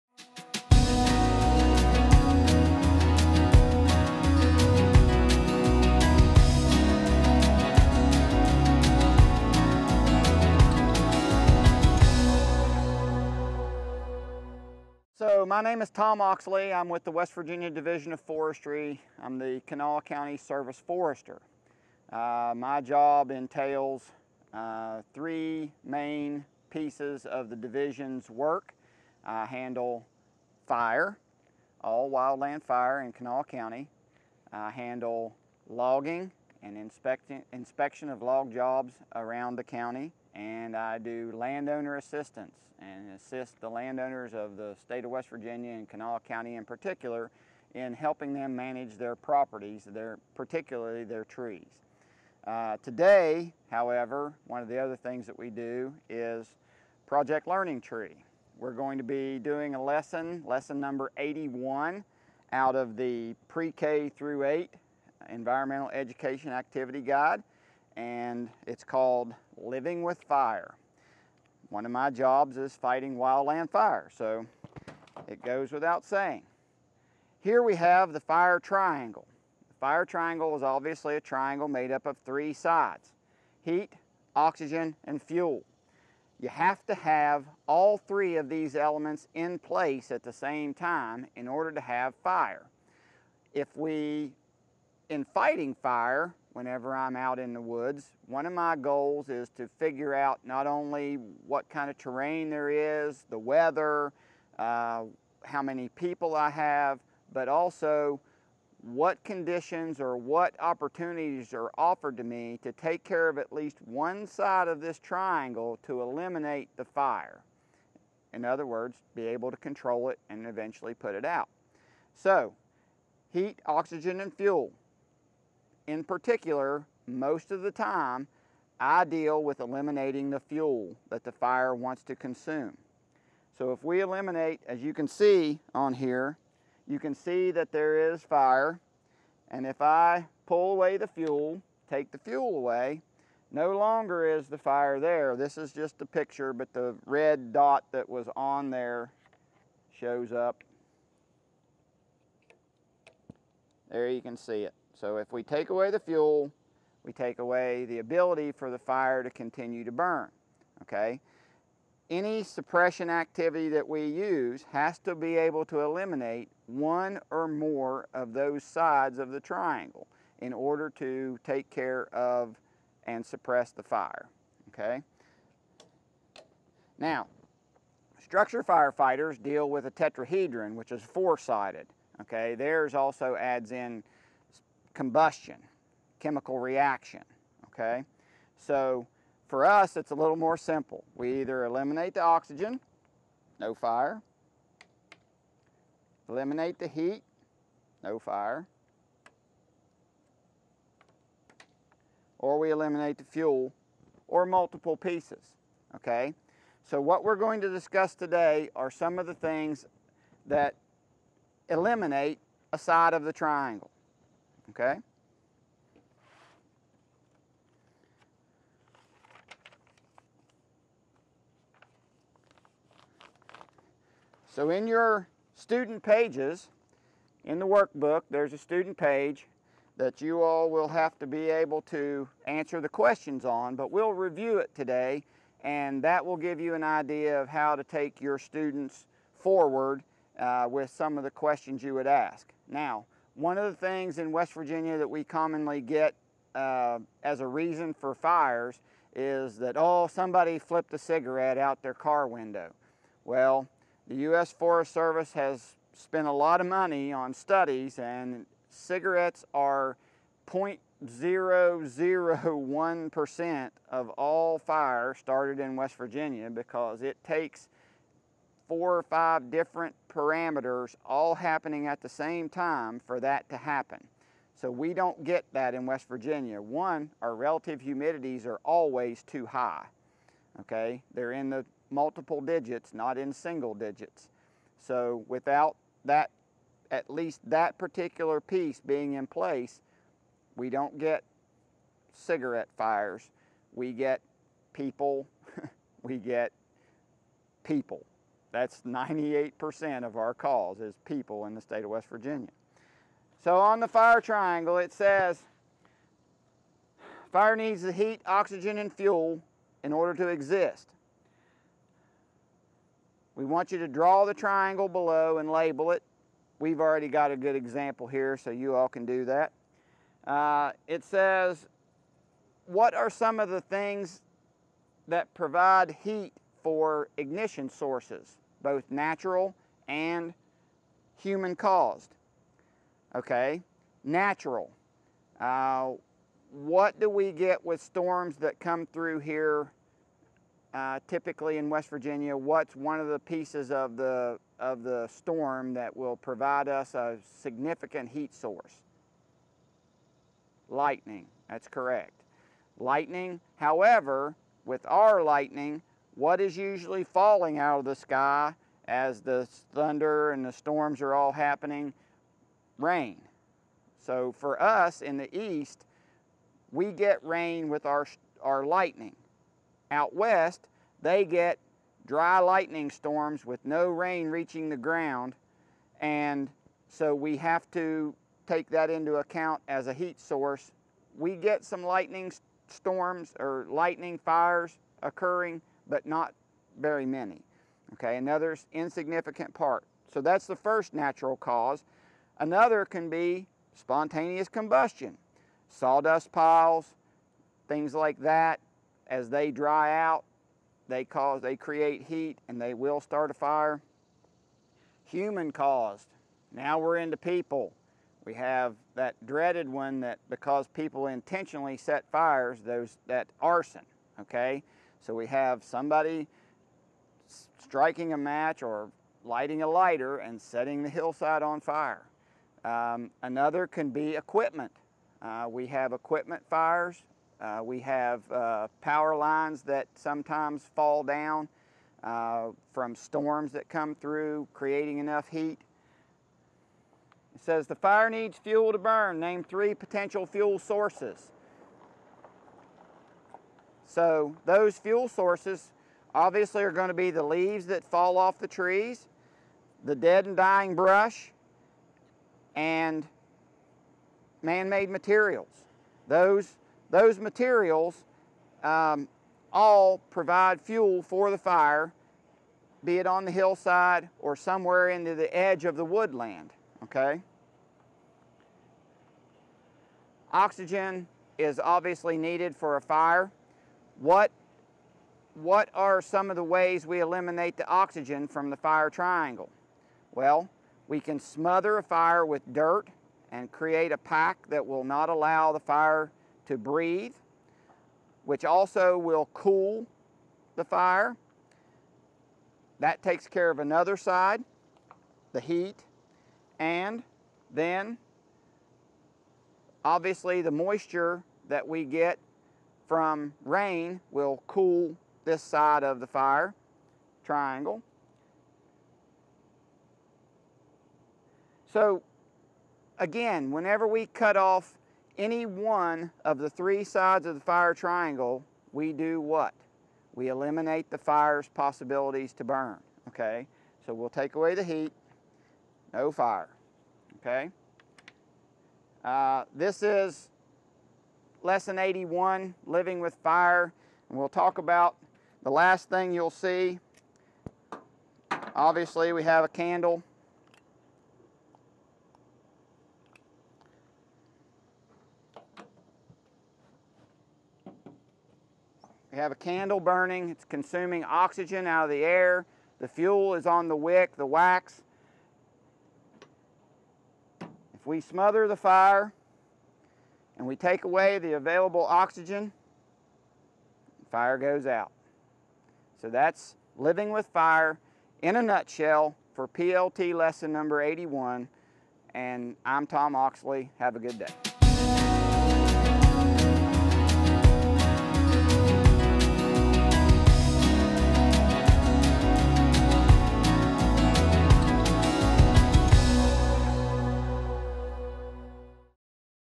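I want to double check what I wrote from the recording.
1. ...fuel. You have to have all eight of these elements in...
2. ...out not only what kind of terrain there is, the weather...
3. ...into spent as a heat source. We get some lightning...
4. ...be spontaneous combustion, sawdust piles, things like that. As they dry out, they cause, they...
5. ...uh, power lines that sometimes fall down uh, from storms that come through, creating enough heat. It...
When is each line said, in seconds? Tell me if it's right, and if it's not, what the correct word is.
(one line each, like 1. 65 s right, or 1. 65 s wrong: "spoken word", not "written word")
1. 85 s wrong: "three", not "eight"
2. 100 s right
3. 378 s wrong: "account", not "spent"
4. 393 s right
5. 428 s right.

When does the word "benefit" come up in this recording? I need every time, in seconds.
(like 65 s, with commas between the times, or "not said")
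not said.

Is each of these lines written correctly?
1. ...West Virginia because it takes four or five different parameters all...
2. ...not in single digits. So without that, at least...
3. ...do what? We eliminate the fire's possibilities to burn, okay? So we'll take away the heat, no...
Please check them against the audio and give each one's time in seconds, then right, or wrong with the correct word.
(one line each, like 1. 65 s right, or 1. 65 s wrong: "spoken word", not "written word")
1. 265 s right
2. 282 s right
3. 518 s right.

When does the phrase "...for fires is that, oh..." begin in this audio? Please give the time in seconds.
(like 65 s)
247 s.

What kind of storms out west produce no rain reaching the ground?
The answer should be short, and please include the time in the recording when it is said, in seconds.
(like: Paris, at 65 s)
dry lightning storms, at 372 s.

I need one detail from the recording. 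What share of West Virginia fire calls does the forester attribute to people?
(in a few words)
98%.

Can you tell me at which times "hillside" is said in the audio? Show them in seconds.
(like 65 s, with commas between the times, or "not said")
420 s, 463 s.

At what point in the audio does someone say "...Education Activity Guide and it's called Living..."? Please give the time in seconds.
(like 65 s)
65 s.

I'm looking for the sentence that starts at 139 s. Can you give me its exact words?
And if I pull away the fuel, take the fuel away, no longer is the fire there.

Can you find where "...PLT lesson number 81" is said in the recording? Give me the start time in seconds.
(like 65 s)
569 s.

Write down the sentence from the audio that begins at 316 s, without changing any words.
We've already got a good example here, so you all can do that.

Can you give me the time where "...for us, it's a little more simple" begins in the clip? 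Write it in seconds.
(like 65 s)
189 s.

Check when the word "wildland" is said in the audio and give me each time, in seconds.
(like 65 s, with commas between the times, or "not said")
32 s, 73 s.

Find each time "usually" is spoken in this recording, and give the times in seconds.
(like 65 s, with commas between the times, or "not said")
356 s.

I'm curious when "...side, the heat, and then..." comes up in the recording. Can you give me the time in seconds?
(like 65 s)
493 s.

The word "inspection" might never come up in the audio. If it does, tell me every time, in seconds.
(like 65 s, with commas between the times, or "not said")
36 s.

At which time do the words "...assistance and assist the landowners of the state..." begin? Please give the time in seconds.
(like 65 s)
41 s.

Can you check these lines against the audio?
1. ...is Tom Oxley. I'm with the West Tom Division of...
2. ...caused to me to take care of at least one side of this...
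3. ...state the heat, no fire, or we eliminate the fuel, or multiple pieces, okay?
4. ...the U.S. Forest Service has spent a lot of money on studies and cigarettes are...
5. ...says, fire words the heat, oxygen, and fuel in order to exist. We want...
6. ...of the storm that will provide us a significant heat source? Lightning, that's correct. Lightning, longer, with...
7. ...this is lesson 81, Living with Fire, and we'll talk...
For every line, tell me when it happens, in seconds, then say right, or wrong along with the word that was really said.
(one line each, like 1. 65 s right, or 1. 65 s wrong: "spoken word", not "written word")
1. 15 s wrong: "Virginia", not "Tom"
2. 111 s wrong: "offered", not "caused"
3. 196 s wrong: "eliminate", not "state"
4. 254 s right
5. 304 s wrong: "needs", not "words"
6. 344 s wrong: "however", not "longer"
7. 529 s right.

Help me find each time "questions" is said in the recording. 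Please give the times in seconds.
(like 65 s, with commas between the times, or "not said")
232 s, 241 s.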